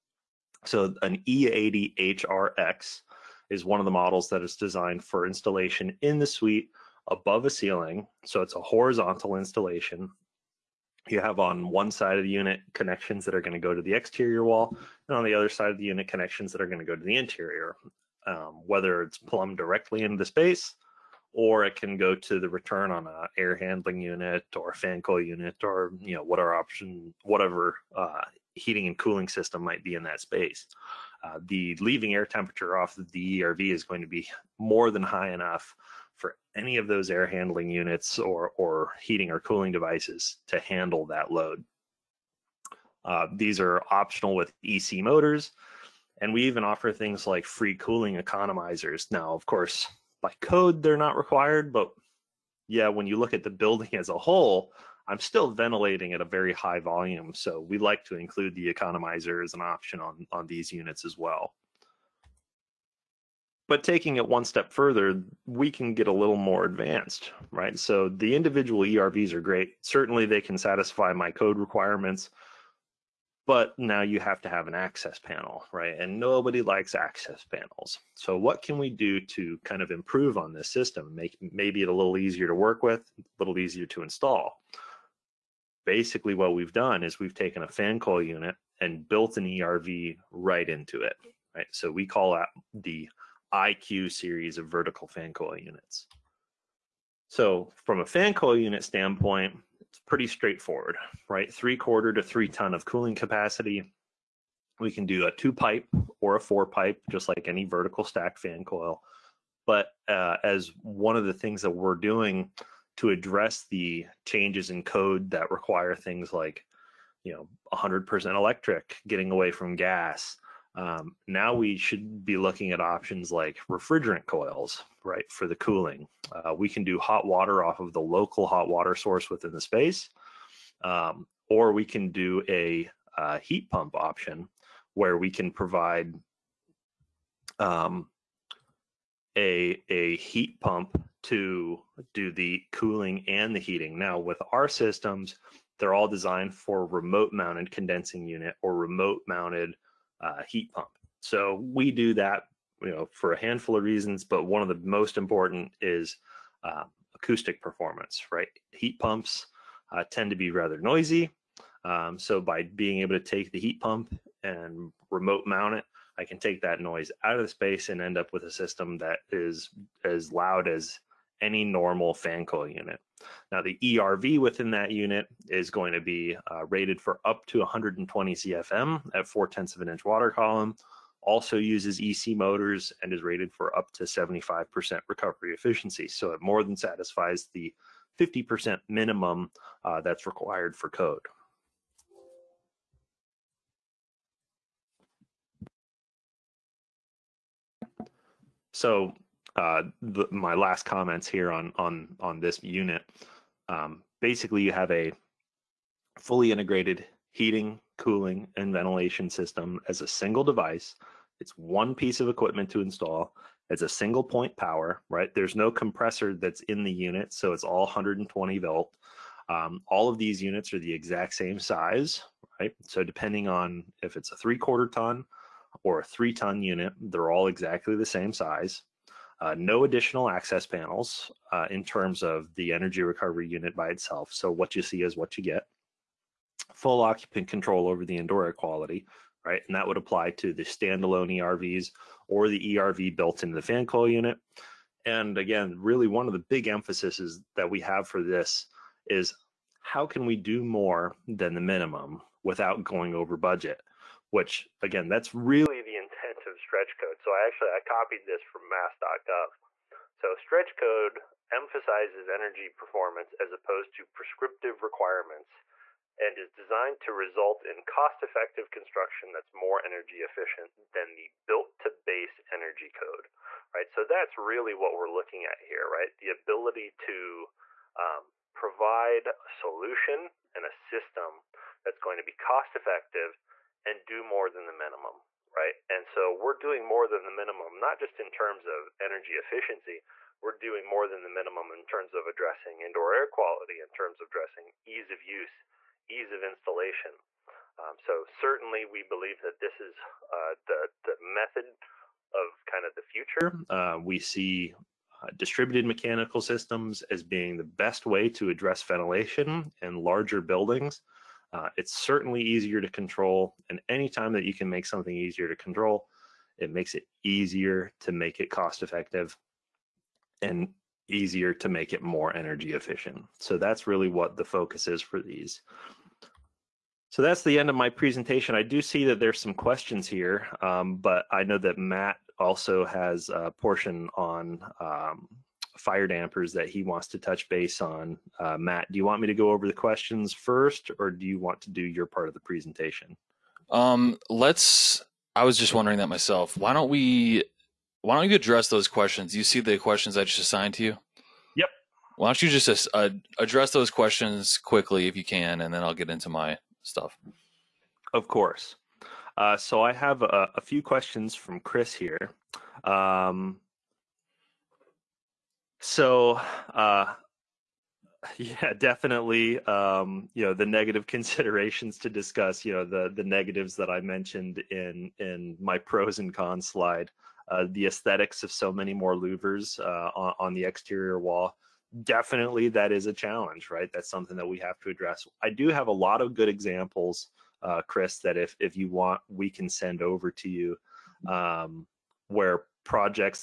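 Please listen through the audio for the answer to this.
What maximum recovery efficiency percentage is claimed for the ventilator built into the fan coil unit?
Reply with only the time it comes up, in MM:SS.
03:04.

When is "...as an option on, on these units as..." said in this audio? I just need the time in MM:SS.
00:59.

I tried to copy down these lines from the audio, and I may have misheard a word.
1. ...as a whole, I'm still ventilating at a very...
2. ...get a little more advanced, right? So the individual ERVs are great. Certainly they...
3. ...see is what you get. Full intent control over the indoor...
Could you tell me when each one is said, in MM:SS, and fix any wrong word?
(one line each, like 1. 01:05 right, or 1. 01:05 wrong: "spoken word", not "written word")
1. 00:53 right
2. 01:05 right
3. 03:54 wrong: "occupant", not "intent".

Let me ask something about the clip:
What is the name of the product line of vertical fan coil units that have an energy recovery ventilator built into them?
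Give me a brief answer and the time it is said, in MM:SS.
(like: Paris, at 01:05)
IQ series, at 01:33.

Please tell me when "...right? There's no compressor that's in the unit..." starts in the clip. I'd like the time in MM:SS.
03:35.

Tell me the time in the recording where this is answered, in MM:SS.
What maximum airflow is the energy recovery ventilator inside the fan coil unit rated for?
02:57.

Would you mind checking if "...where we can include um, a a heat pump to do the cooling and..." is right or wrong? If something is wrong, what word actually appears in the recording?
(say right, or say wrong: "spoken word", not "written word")
wrong: "provide", not "include".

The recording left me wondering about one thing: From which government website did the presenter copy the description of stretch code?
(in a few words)
mass.gov.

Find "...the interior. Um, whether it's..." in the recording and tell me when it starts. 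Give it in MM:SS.
00:17.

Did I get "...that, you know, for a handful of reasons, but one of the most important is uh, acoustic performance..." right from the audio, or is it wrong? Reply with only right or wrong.
right.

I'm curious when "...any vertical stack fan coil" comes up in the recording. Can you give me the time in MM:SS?
01:47.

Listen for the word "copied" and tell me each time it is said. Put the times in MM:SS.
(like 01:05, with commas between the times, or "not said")
04:17.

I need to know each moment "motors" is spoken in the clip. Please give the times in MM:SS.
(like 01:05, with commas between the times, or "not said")
00:45, 03:02.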